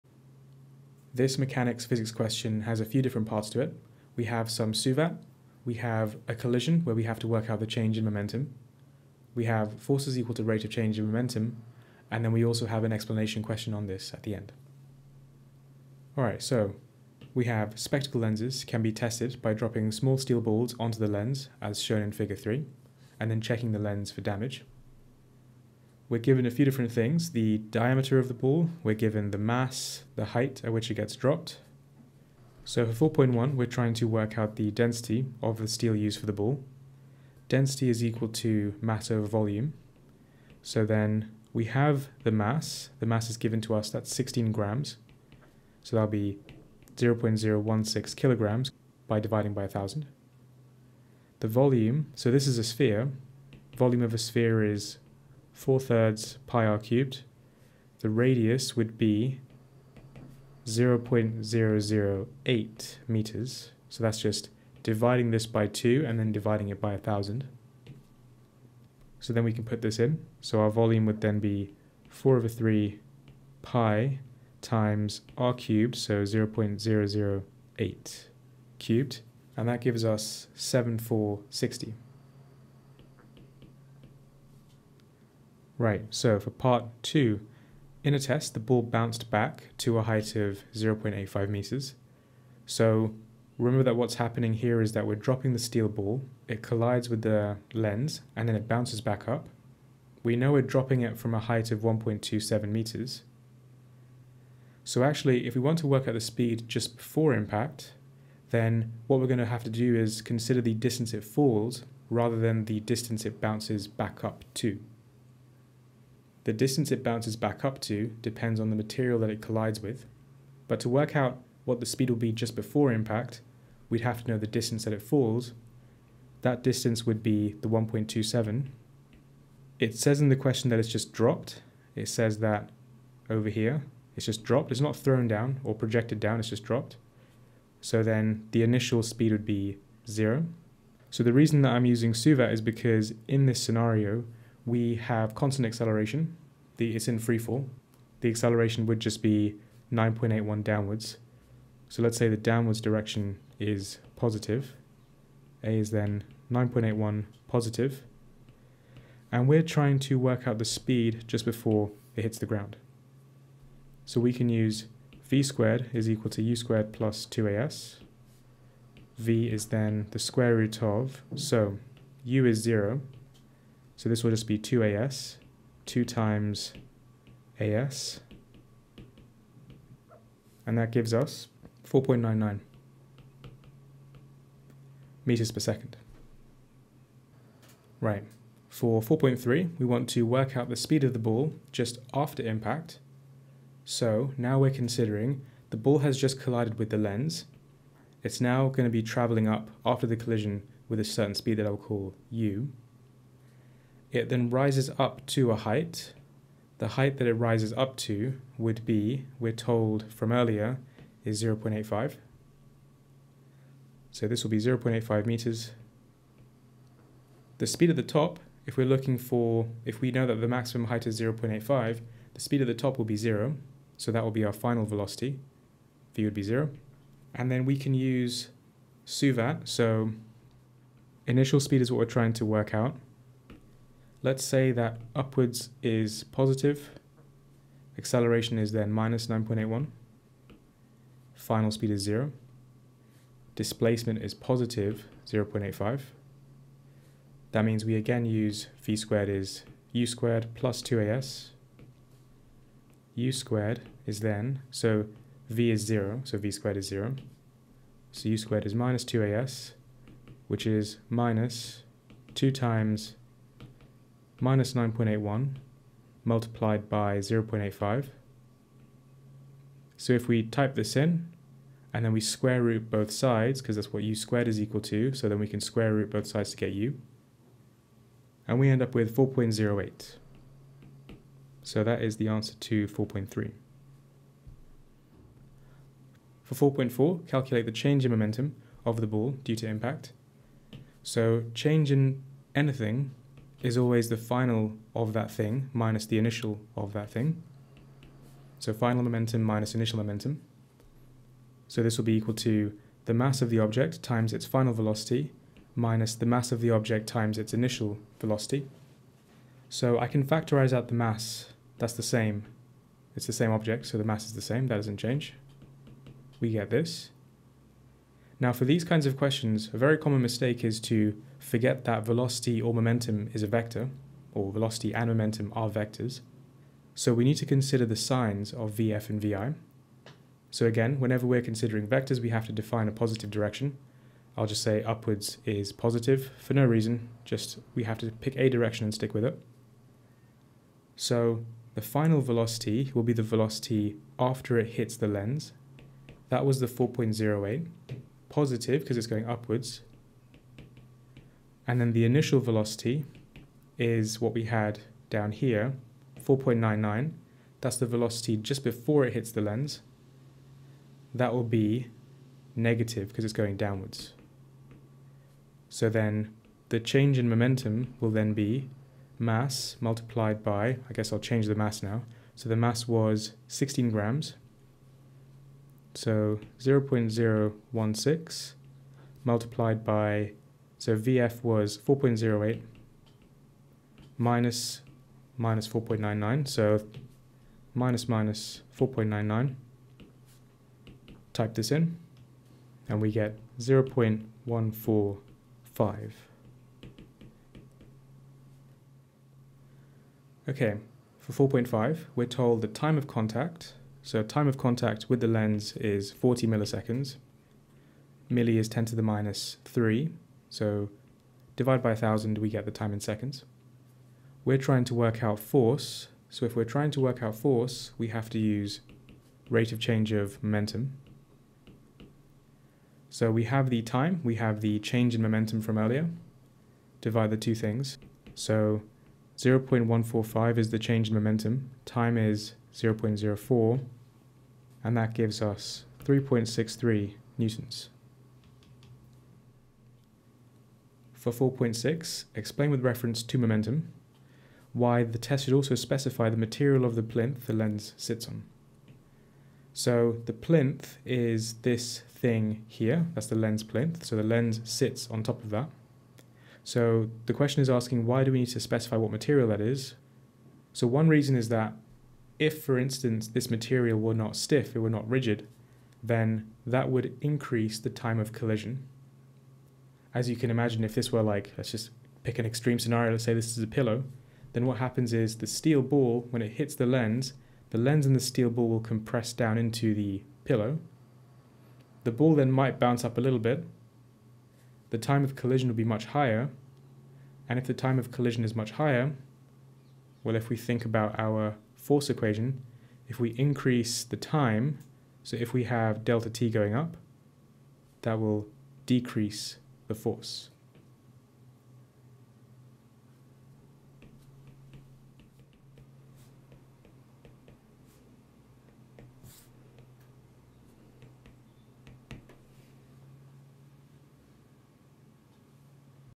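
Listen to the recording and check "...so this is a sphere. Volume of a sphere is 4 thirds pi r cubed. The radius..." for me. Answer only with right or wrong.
right.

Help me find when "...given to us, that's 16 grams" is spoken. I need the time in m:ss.
0:43.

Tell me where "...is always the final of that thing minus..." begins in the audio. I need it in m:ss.
4:53.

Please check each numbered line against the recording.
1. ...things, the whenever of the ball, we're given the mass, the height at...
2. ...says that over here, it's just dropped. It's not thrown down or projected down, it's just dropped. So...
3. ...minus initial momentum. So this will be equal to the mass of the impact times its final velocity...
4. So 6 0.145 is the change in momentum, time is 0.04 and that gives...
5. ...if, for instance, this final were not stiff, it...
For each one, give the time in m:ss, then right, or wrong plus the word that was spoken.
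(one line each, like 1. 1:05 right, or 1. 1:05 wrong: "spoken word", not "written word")
1. 0:26 wrong: "diameter", not "whenever"
2. 2:12 right
3. 4:59 wrong: "object", not "impact"
4. 7:08 wrong: "0", not "6"
5. 7:42 wrong: "material", not "final".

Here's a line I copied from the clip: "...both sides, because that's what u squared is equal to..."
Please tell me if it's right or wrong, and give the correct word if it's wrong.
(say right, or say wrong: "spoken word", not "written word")
right.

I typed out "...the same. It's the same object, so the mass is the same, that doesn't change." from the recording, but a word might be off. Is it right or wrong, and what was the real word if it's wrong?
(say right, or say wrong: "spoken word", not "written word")
right.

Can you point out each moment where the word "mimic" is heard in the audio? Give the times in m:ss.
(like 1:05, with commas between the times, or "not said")
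not said.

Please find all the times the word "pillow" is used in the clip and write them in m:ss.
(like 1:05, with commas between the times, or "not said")
7:53, 8:00.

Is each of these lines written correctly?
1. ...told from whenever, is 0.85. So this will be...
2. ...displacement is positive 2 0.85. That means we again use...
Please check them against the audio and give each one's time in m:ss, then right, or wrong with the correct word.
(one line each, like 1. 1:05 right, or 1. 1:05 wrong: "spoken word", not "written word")
1. 3:29 wrong: "earlier", not "whenever"
2. 4:03 wrong: "0", not "2".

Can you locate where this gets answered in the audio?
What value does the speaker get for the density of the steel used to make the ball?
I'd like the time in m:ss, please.
1:20.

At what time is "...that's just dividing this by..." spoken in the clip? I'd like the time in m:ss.
1:04.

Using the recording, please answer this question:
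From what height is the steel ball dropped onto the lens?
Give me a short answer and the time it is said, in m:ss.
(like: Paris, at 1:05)
1.27 meters, at 1:41.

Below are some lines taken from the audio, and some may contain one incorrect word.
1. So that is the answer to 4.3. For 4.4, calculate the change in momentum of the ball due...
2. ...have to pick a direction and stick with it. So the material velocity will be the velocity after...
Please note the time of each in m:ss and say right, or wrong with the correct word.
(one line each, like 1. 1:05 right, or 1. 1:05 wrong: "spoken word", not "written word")
1. 4:41 right
2. 5:37 wrong: "final", not "material".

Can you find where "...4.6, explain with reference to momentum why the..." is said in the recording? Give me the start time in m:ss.
7:21.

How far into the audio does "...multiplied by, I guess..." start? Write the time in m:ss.
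6:09.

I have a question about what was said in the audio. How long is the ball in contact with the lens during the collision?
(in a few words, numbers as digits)
40 milliseconds.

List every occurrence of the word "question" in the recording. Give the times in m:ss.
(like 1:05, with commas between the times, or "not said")
0:02, 0:13, 2:10, 5:19, 7:37.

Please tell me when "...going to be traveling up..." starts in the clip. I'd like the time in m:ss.
3:18.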